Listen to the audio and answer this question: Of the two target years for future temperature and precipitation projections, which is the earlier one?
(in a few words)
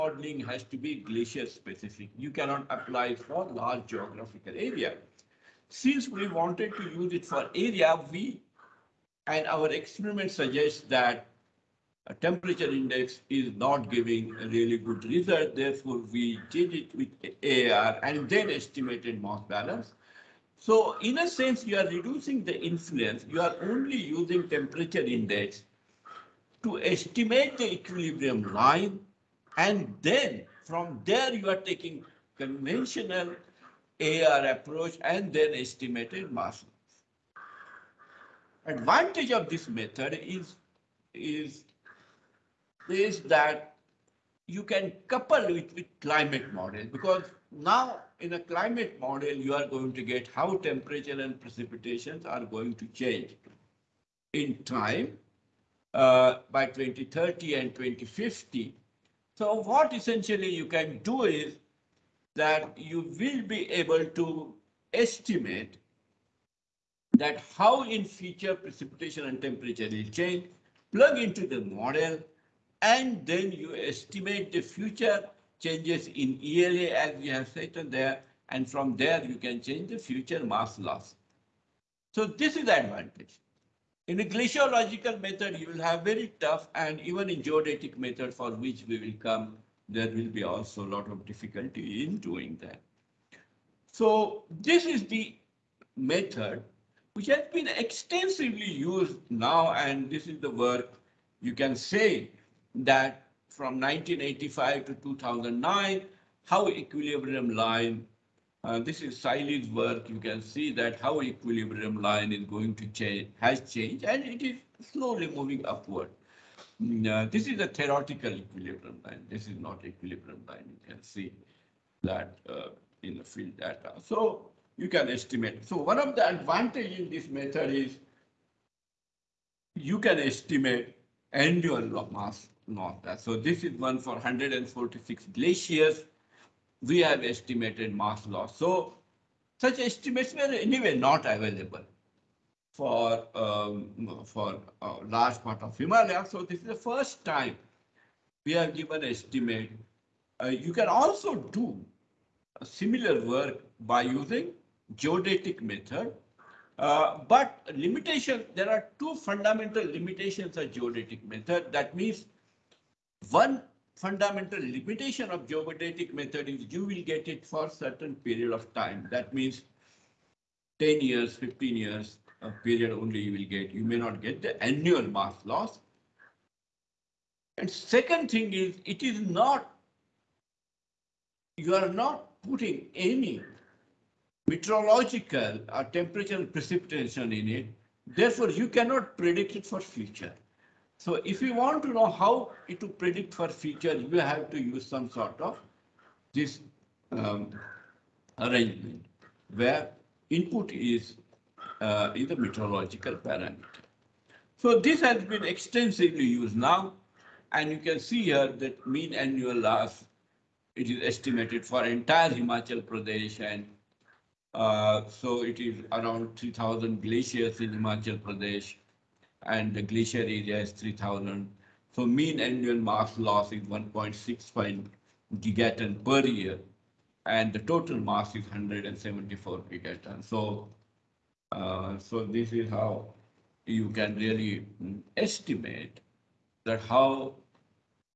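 2030.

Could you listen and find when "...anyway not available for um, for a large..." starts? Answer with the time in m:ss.
2:20.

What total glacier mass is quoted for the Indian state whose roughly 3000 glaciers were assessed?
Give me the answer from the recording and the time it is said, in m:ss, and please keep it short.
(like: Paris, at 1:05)
174 gigatons, at 3:48.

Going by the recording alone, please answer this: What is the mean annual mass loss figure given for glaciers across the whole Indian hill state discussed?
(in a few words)
1.65 gigatons per year.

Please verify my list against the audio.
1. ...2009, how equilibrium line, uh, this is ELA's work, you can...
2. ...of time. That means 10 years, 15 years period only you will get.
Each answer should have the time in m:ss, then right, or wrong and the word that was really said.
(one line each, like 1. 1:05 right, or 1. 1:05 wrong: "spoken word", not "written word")
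1. 1:45 wrong: "Siley", not "ELA"
2. 2:48 right.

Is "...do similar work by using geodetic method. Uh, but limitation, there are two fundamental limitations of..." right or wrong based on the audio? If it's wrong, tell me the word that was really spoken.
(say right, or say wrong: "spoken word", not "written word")
right.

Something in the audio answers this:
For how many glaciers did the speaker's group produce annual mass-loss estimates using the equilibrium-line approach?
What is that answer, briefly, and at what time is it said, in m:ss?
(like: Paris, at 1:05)
146, at 2:14.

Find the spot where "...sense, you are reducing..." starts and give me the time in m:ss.
0:21.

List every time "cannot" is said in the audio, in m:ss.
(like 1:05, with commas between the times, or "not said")
0:02, 3:08.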